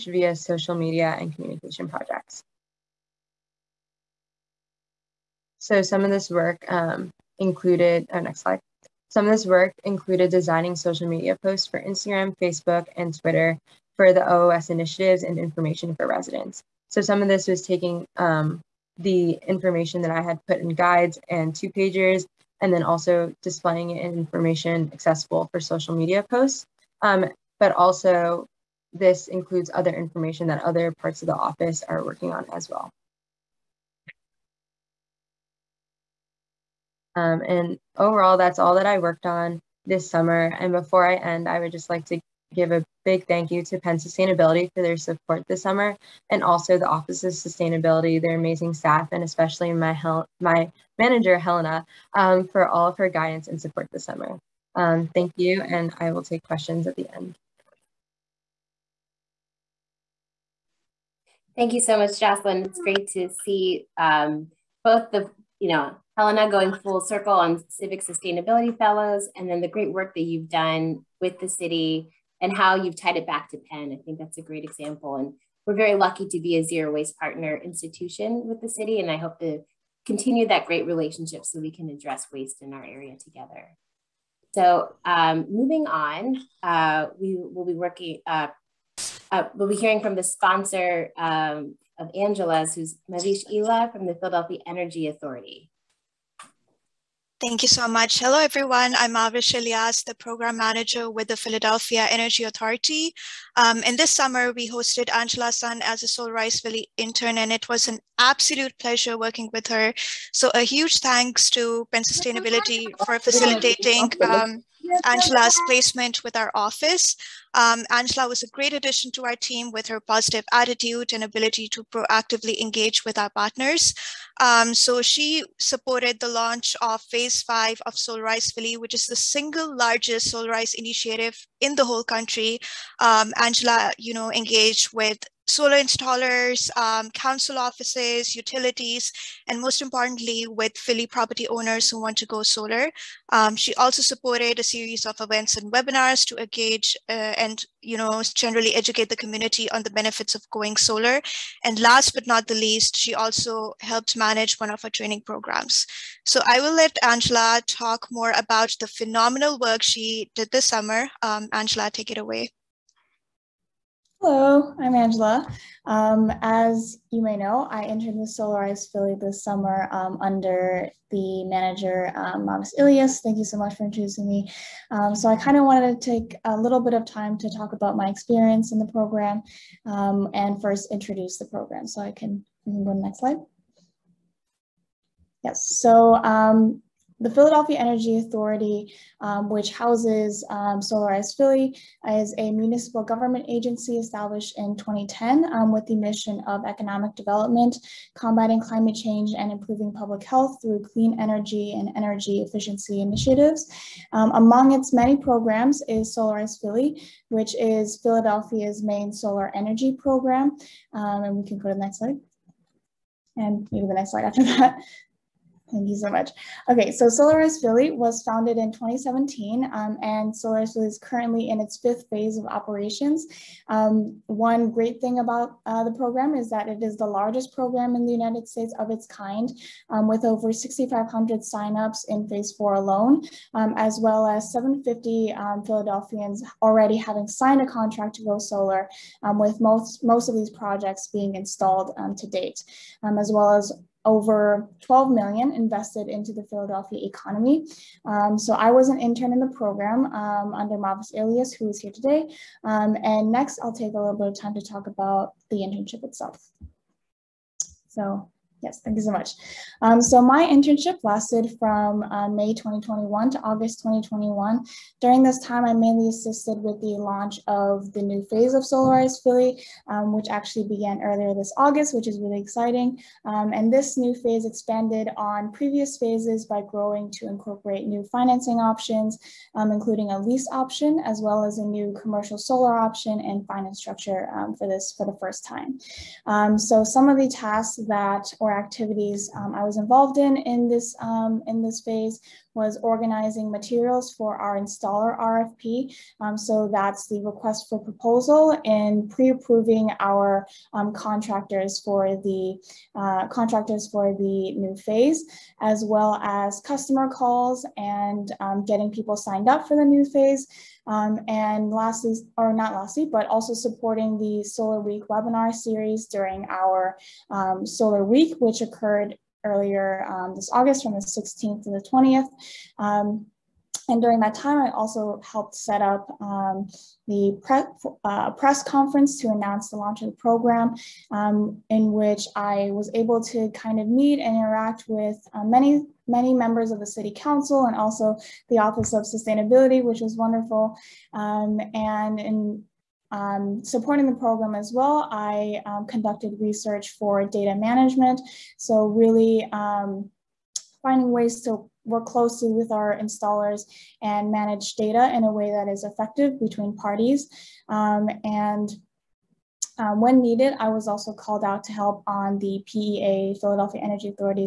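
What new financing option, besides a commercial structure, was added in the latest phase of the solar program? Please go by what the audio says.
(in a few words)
a lease option.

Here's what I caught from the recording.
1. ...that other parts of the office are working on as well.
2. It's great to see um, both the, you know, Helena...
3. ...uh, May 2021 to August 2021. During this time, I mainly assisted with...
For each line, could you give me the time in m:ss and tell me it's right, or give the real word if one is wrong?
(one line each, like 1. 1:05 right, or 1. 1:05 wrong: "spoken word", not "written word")
1. 0:30 right
2. 1:02 right
3. 4:22 right.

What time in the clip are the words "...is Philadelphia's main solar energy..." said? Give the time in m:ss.
3:27.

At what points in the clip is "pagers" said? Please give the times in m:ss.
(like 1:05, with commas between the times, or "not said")
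0:21.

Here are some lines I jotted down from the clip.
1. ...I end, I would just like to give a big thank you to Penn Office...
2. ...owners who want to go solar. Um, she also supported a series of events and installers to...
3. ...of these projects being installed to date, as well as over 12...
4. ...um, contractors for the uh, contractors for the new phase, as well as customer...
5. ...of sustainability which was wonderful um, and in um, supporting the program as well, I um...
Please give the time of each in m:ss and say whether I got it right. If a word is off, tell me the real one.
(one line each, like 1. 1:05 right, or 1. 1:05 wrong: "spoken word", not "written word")
1. 0:41 wrong: "Sustainability", not "Office"
2. 2:21 wrong: "webinars", not "installers"
3. 4:00 right
4. 5:00 right
5. 5:38 right.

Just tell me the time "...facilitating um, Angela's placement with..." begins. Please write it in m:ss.
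1:53.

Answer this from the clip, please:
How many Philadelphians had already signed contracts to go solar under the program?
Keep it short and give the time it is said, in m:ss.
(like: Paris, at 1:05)
750, at 3:54.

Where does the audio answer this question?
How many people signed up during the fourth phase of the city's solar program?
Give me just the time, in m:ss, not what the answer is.
3:50.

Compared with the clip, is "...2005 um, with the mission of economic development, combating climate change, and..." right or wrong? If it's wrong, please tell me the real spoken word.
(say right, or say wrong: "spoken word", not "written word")
wrong: "2010", not "2005".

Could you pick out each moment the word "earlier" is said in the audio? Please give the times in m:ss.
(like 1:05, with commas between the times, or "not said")
4:31, 5:19.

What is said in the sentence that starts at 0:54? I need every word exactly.
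Um, thank you, and I will take questions at the end.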